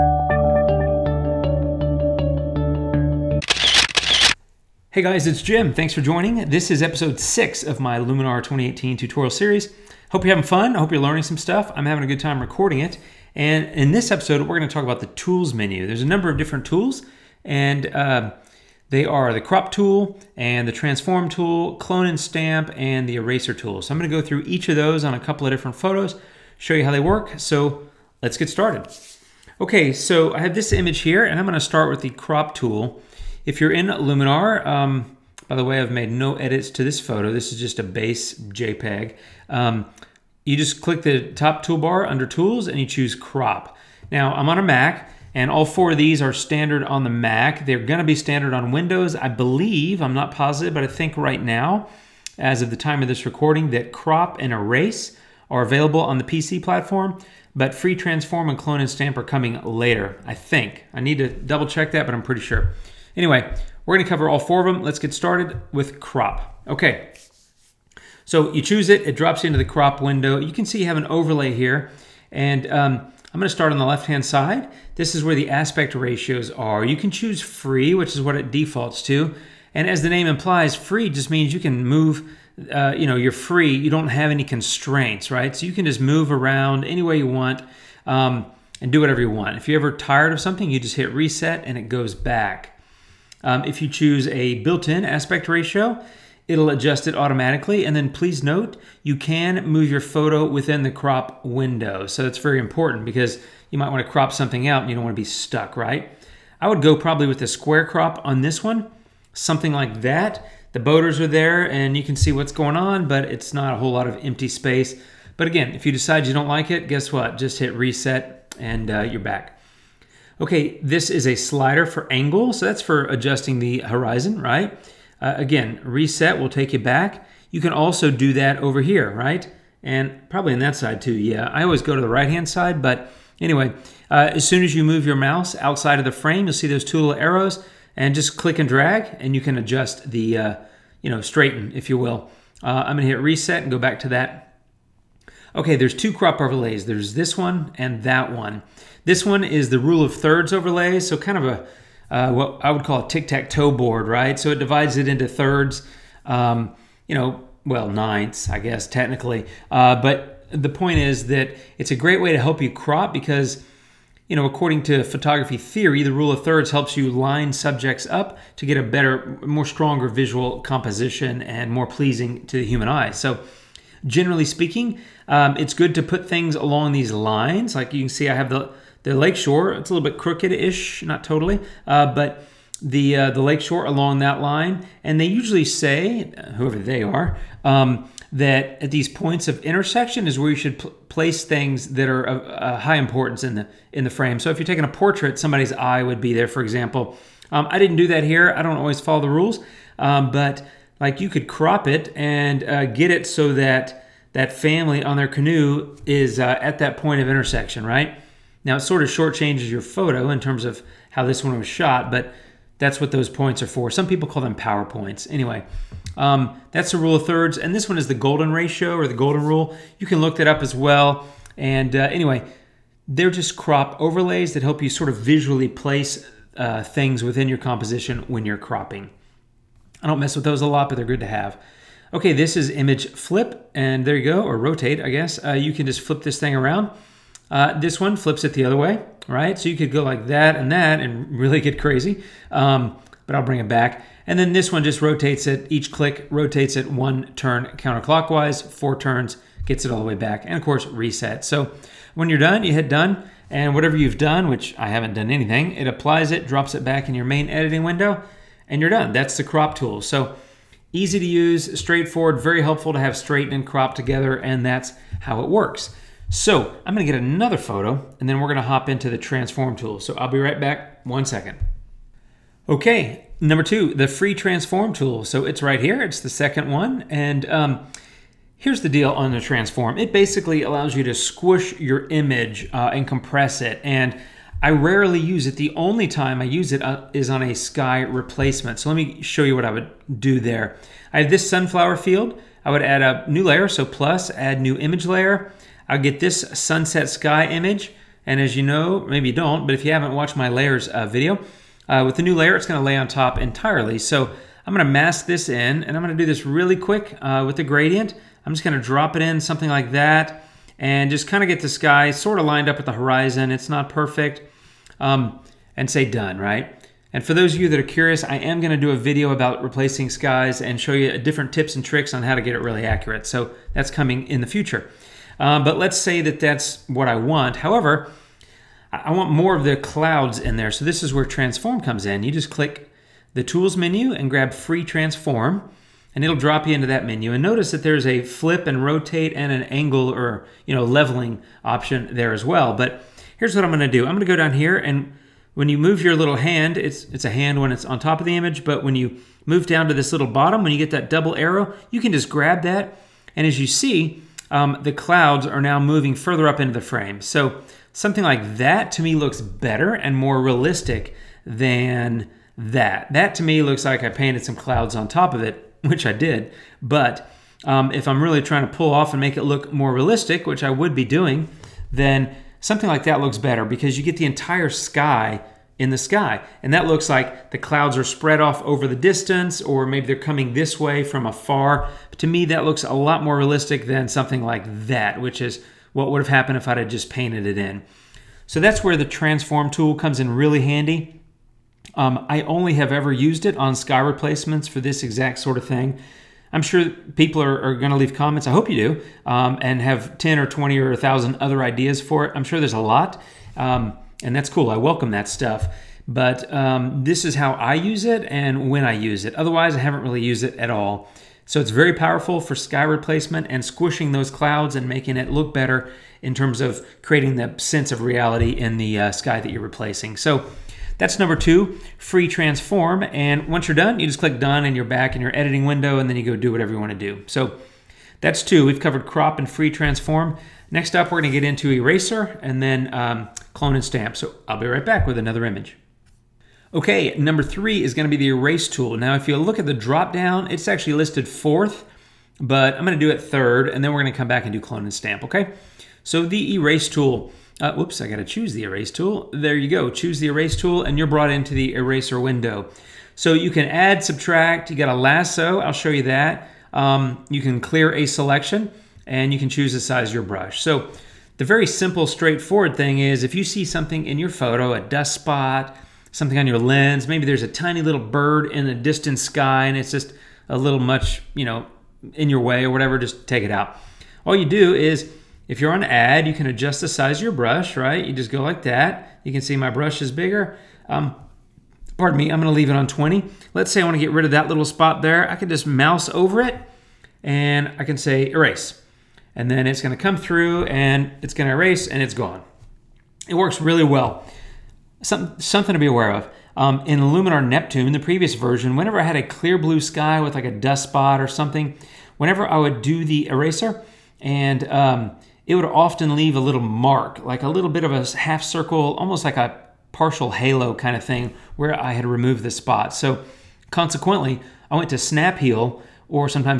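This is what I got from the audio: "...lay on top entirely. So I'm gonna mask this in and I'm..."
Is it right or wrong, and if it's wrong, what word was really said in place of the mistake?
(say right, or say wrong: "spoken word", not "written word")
right.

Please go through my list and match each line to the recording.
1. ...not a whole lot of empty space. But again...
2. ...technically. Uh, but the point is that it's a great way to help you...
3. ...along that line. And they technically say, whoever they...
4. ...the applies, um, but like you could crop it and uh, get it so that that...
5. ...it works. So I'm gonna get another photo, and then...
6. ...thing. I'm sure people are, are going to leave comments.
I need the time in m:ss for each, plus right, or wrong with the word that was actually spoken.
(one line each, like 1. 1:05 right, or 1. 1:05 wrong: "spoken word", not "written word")
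1. 1:53 right
2. 2:38 right
3. 3:03 wrong: "usually", not "technically"
4. 3:19 wrong: "rules", not "applies"
5. 4:25 right
6. 6:35 right.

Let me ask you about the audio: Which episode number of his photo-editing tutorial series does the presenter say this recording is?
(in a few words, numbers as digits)
6.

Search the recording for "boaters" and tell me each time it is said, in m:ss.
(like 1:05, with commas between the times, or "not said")
1:50.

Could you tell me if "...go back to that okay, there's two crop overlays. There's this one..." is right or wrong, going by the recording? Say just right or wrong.
right.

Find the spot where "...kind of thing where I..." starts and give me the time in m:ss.
8:30.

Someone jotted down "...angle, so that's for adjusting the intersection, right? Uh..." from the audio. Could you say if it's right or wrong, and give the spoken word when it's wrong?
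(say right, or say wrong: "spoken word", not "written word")
wrong: "horizon", not "intersection".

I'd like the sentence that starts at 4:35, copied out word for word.
So it's right here, it's the second one, and um, Here's the deal on the transform.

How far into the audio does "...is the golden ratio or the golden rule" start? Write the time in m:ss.
3:37.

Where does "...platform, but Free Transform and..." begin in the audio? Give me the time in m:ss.
0:56.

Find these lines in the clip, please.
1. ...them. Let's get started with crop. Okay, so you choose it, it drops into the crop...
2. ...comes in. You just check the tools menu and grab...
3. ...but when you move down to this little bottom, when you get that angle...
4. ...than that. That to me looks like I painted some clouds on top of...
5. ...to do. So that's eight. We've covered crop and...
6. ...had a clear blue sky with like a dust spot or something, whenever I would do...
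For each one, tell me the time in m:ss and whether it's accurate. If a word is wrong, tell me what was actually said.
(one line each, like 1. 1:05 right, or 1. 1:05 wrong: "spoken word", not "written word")
1. 1:04 right
2. 5:31 wrong: "click", not "check"
3. 5:48 wrong: "double", not "angle"
4. 6:01 right
5. 7:06 wrong: "two", not "eight"
6. 8:19 right.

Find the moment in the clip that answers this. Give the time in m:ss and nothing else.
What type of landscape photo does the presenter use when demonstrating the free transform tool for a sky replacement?
4:51.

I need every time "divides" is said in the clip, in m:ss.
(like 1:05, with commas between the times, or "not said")
2:34.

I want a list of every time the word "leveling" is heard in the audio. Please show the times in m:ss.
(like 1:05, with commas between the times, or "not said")
5:40.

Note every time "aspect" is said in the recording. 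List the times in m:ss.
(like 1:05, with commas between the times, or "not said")
1:15, 1:35.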